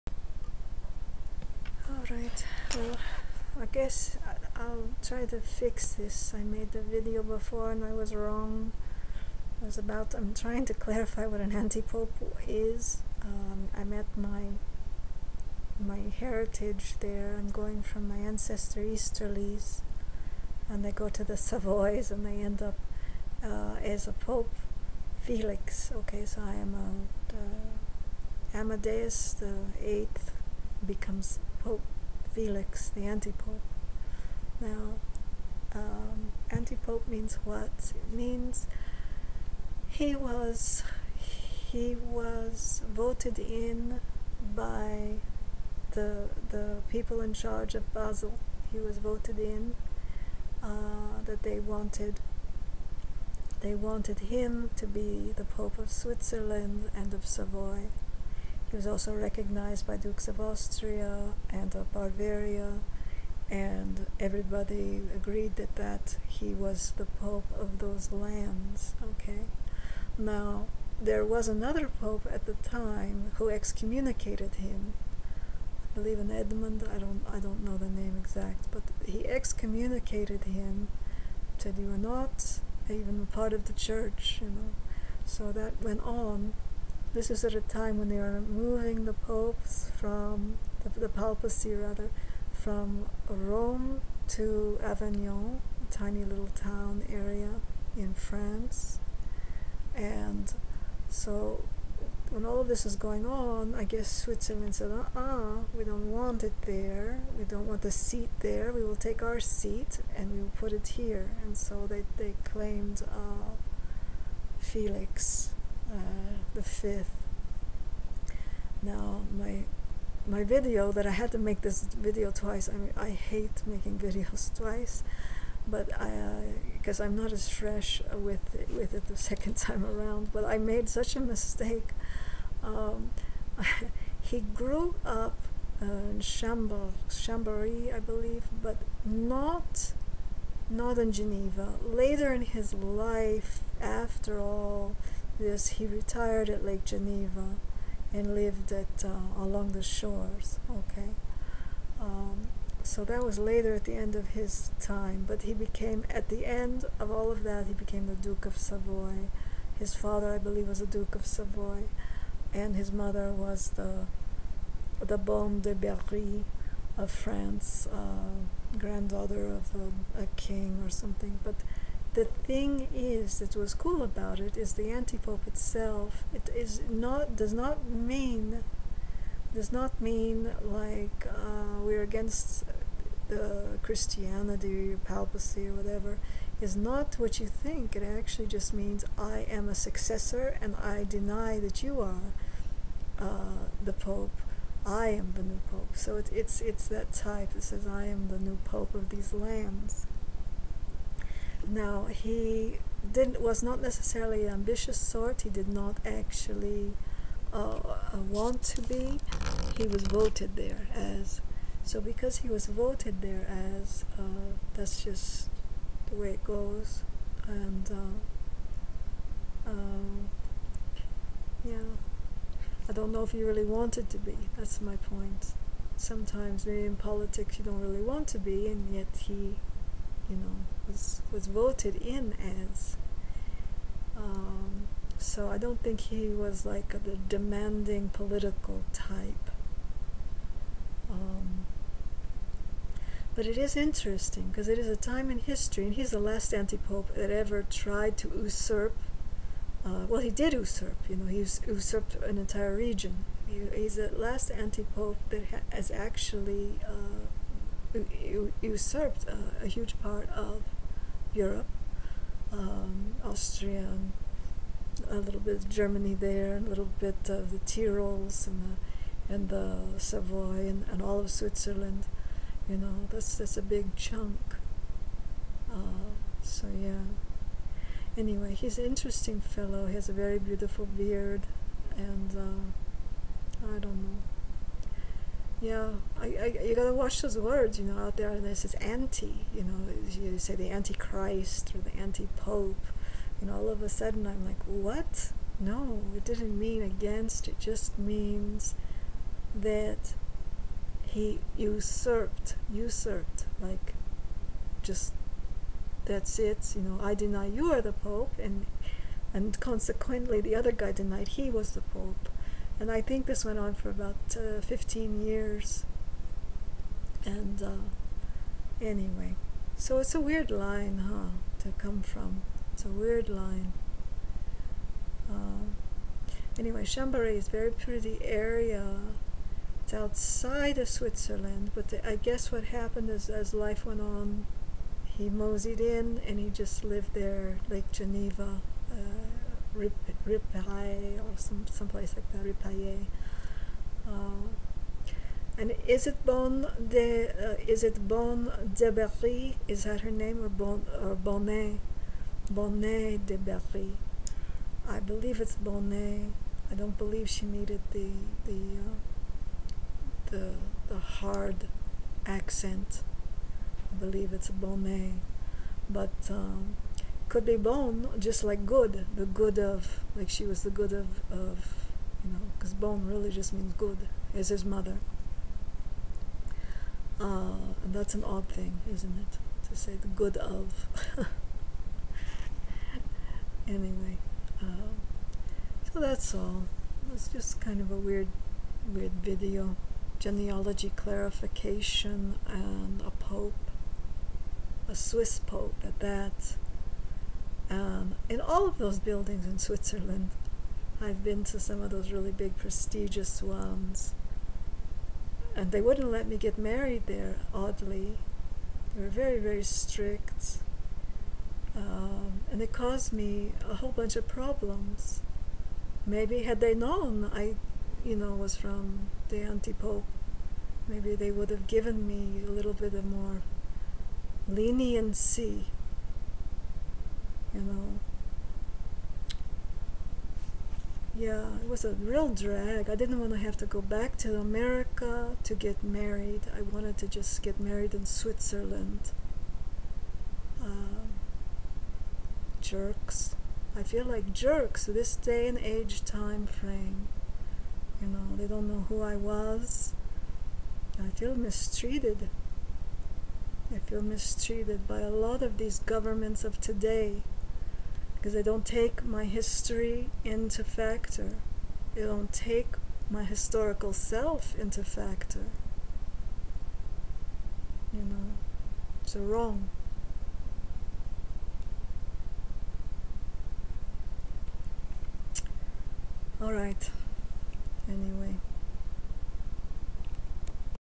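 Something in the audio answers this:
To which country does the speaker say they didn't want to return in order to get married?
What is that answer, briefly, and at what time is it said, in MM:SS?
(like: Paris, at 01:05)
America, at 07:14.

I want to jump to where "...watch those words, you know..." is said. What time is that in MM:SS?
04:46.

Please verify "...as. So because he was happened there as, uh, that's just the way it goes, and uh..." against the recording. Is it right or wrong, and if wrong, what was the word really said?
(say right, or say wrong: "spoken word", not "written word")
wrong: "voted", not "happened".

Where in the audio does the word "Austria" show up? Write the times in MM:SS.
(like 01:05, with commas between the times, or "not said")
01:00, 04:23.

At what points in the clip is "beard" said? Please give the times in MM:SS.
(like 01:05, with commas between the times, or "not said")
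04:40.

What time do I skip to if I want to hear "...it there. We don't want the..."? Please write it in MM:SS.
01:46.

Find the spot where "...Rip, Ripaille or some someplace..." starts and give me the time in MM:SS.
05:39.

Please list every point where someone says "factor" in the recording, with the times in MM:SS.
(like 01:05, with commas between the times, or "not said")
07:40, 07:44.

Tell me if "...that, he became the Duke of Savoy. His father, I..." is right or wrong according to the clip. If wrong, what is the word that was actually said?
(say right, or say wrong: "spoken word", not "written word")
right.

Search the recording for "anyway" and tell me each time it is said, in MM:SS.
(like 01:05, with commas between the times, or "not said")
04:38, 05:18, 05:26, 06:23, 07:57.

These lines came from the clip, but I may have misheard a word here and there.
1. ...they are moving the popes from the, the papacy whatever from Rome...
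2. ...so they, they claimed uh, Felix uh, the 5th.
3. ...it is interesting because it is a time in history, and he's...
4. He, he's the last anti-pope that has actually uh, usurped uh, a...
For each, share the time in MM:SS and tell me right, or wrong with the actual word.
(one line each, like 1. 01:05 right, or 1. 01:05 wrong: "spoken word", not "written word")
1. 01:28 wrong: "rather", not "whatever"
2. 01:51 right
3. 04:03 right
4. 04:13 right.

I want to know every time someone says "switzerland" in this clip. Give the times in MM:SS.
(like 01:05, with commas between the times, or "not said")
00:55, 01:44, 04:31, 05:30, 06:39, 07:18.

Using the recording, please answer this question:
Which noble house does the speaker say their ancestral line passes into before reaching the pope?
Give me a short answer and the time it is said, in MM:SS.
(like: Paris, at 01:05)
Savoys, at 00:21.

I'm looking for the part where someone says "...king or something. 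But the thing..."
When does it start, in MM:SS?
02:50.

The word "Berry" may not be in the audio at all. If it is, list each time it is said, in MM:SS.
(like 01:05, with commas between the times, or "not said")
02:45, 05:48, 05:53.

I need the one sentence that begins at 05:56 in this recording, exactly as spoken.
I don't believe she needed the the uh, the the hard accent.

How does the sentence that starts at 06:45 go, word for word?
And they wouldn't let me get married there, oddly.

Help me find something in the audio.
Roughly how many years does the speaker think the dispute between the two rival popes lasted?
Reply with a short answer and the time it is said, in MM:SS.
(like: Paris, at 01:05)
15, at 05:14.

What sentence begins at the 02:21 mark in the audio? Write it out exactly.
Later in his life, after all, this he retired at Lake Geneva and lived at uh, along the shores.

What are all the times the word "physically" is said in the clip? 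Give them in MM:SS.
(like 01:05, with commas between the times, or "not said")
not said.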